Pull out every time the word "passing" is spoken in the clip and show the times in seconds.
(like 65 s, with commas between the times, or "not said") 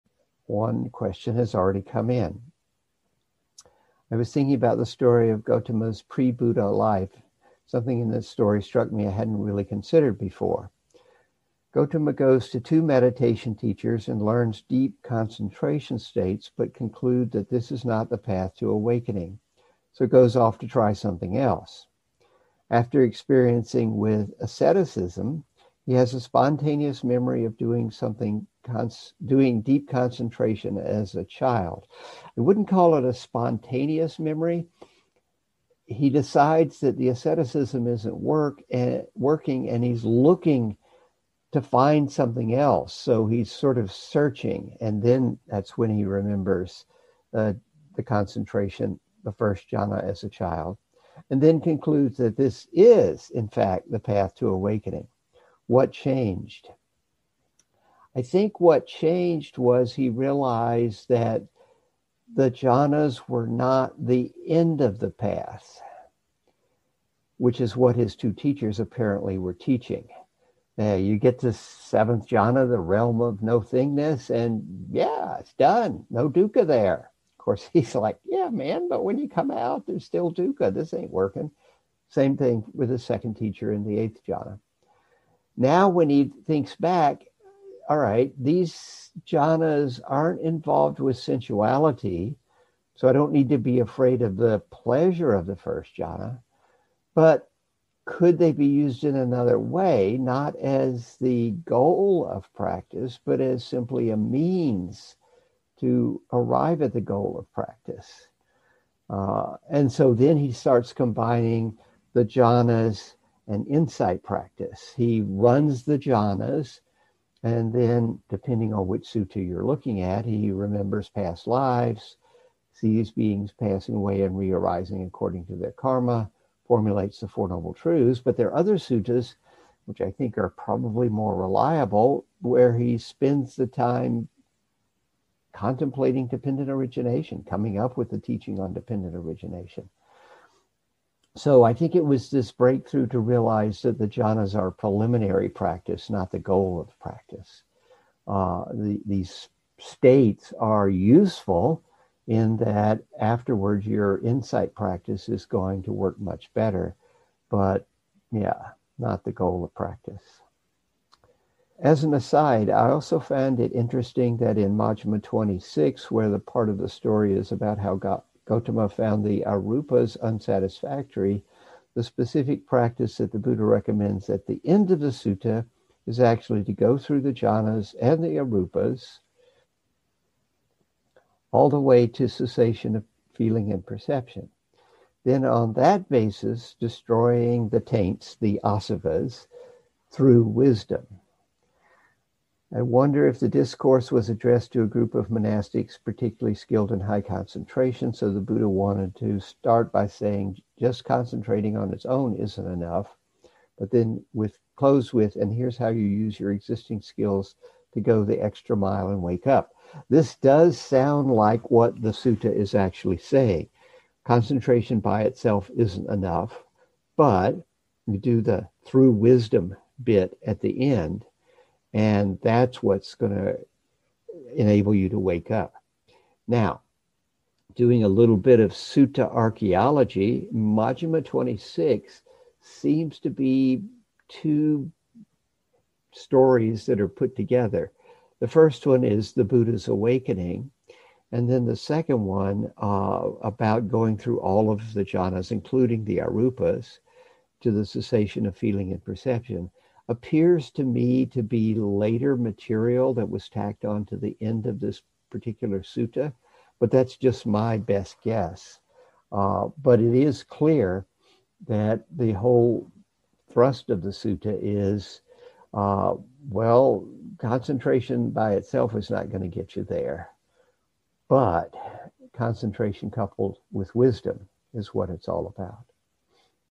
123 s.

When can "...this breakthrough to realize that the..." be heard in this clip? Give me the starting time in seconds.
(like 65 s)
142 s.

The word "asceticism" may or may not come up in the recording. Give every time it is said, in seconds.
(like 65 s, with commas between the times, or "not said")
24 s, 37 s.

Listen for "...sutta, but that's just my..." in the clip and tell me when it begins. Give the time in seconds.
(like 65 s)
255 s.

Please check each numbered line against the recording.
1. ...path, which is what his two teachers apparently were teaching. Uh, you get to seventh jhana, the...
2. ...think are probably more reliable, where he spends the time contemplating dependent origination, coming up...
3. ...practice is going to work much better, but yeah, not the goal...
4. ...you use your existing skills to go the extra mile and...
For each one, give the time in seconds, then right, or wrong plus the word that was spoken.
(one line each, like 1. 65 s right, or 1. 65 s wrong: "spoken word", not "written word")
1. 65 s right
2. 130 s right
3. 154 s right
4. 205 s right.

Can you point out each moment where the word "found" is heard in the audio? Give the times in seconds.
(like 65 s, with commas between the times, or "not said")
163 s, 168 s.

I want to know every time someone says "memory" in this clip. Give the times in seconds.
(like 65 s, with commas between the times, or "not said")
27 s, 34 s.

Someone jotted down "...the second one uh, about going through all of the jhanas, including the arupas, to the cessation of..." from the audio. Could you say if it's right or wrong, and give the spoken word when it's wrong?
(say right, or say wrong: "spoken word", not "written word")
right.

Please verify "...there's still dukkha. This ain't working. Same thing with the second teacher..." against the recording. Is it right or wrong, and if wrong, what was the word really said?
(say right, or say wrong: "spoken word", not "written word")
right.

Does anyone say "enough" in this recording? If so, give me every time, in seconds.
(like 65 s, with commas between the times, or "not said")
202 s, 216 s.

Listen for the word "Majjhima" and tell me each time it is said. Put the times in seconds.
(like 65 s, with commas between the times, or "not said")
164 s, 230 s.